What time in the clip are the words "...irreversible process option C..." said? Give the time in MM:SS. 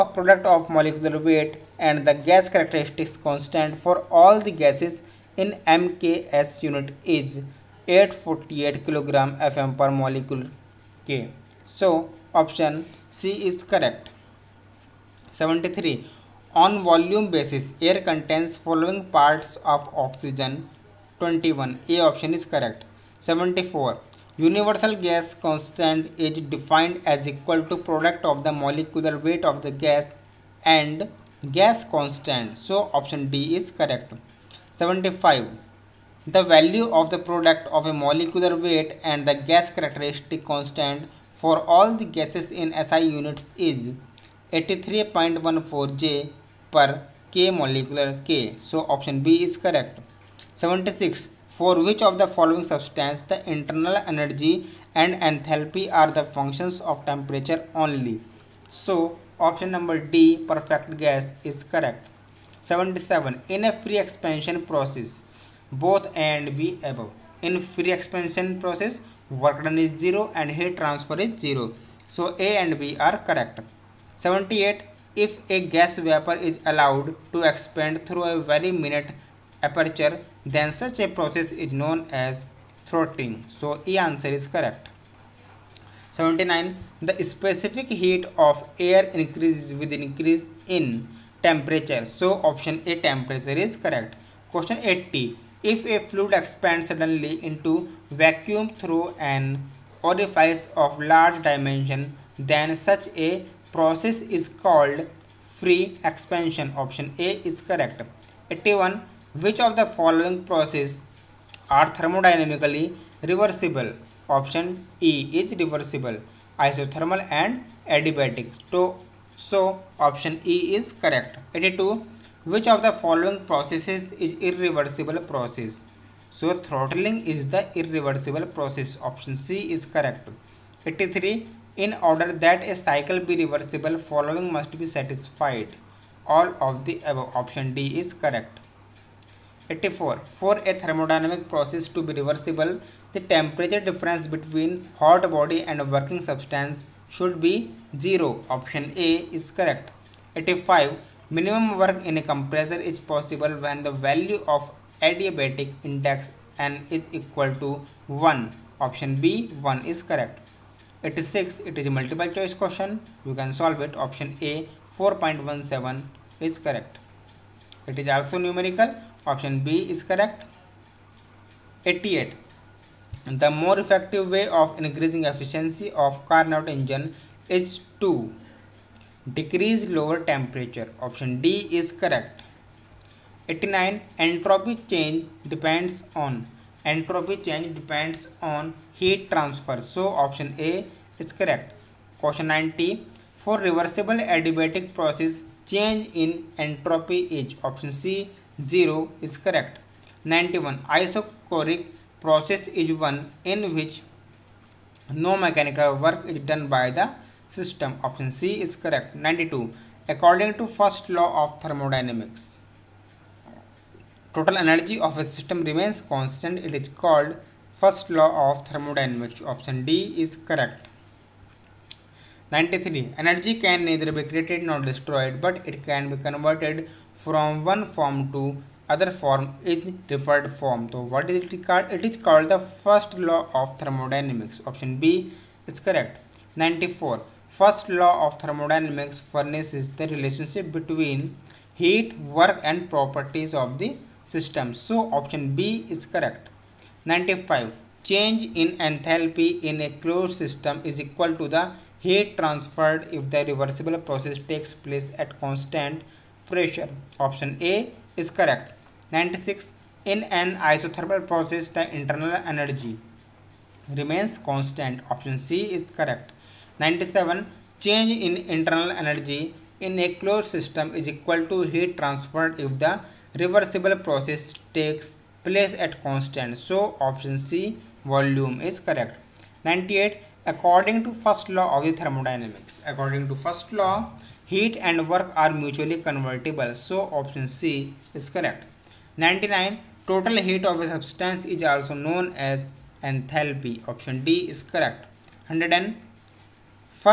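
02:07.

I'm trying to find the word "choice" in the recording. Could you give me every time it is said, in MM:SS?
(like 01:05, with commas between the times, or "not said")
02:42.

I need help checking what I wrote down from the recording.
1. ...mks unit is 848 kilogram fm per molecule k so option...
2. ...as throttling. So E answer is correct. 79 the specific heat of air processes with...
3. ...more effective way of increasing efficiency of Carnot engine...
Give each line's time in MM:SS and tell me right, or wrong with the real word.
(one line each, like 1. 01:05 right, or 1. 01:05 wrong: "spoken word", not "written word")
1. 00:05 right
2. 01:22 wrong: "increases", not "processes"
3. 02:53 right.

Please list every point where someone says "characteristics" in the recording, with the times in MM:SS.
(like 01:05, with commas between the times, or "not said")
00:02, 00:39.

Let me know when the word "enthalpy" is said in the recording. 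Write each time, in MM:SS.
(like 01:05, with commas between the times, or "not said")
00:55, 04:08, 04:53.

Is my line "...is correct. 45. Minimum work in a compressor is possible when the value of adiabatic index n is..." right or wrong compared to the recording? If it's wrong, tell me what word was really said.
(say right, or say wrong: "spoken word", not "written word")
wrong: "85", not "45".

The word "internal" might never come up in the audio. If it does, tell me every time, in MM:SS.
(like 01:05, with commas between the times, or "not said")
00:53, 04:21, 04:28.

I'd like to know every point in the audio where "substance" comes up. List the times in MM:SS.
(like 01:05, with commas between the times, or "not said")
00:52, 02:26, 04:50.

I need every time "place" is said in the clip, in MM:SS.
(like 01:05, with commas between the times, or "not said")
04:14, 04:35.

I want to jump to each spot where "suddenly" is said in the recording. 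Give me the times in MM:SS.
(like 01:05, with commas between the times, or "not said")
01:36.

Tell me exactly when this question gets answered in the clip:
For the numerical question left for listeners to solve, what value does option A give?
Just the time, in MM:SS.
02:44.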